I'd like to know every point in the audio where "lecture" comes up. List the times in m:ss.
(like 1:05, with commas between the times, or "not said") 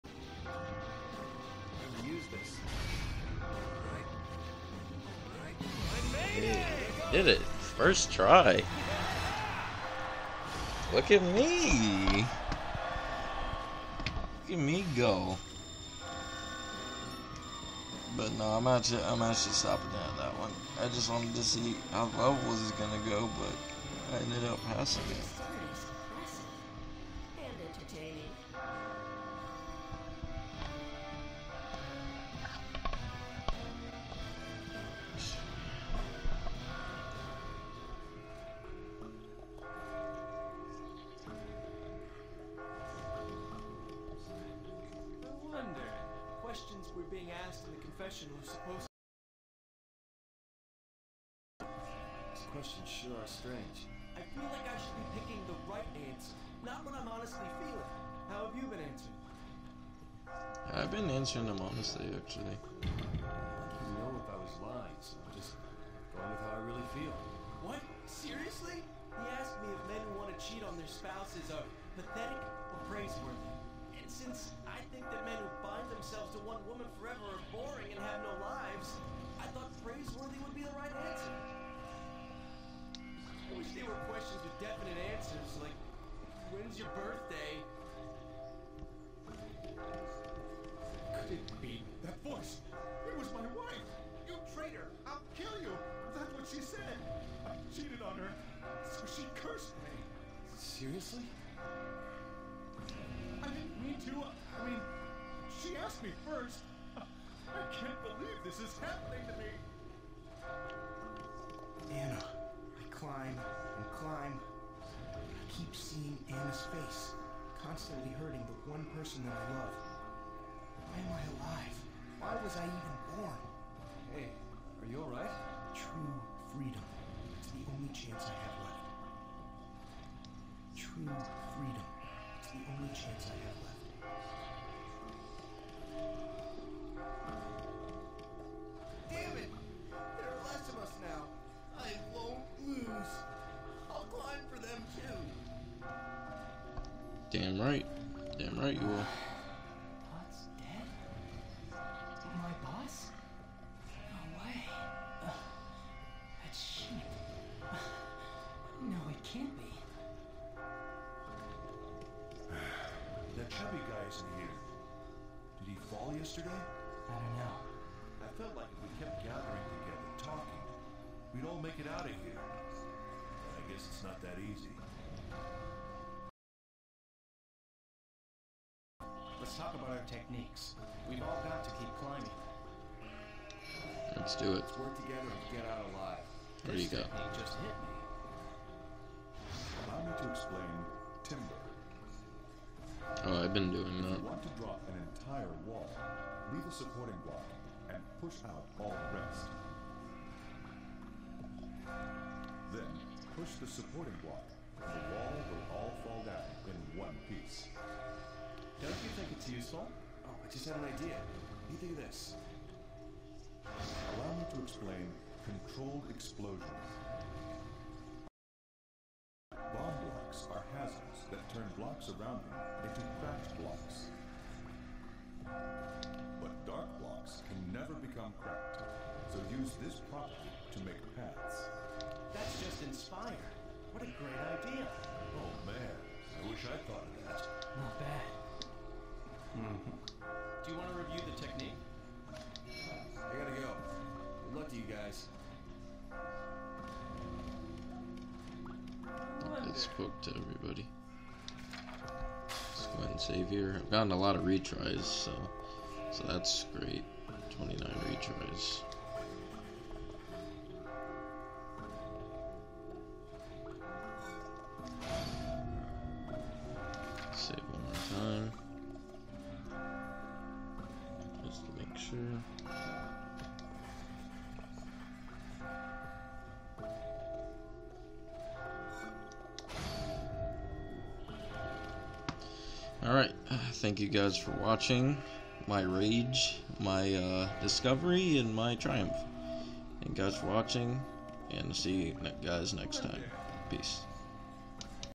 not said.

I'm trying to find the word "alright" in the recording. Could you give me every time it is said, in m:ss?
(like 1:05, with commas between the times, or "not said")
2:05, 4:43.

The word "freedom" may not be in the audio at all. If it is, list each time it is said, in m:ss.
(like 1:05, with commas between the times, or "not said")
2:06, 2:11.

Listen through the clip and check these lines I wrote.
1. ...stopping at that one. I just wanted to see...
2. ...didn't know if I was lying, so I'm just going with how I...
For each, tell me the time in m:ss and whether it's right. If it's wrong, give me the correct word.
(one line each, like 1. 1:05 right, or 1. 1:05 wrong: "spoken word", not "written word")
1. 0:19 right
2. 1:02 right.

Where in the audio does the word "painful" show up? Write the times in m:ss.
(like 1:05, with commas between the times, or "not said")
not said.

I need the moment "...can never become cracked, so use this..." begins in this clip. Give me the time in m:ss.
3:47.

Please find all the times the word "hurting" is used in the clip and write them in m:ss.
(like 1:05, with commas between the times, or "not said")
1:58.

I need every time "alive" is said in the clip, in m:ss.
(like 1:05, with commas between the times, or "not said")
2:01, 3:05.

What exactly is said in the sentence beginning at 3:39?
Bomb blocks are hazards that turn blocks around them into cracked blocks.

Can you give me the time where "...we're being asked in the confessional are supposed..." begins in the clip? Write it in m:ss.
0:46.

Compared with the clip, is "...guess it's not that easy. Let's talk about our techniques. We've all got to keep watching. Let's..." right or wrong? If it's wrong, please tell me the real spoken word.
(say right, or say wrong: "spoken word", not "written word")
wrong: "climbing", not "watching".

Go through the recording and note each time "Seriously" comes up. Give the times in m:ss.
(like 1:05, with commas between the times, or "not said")
1:08, 1:40.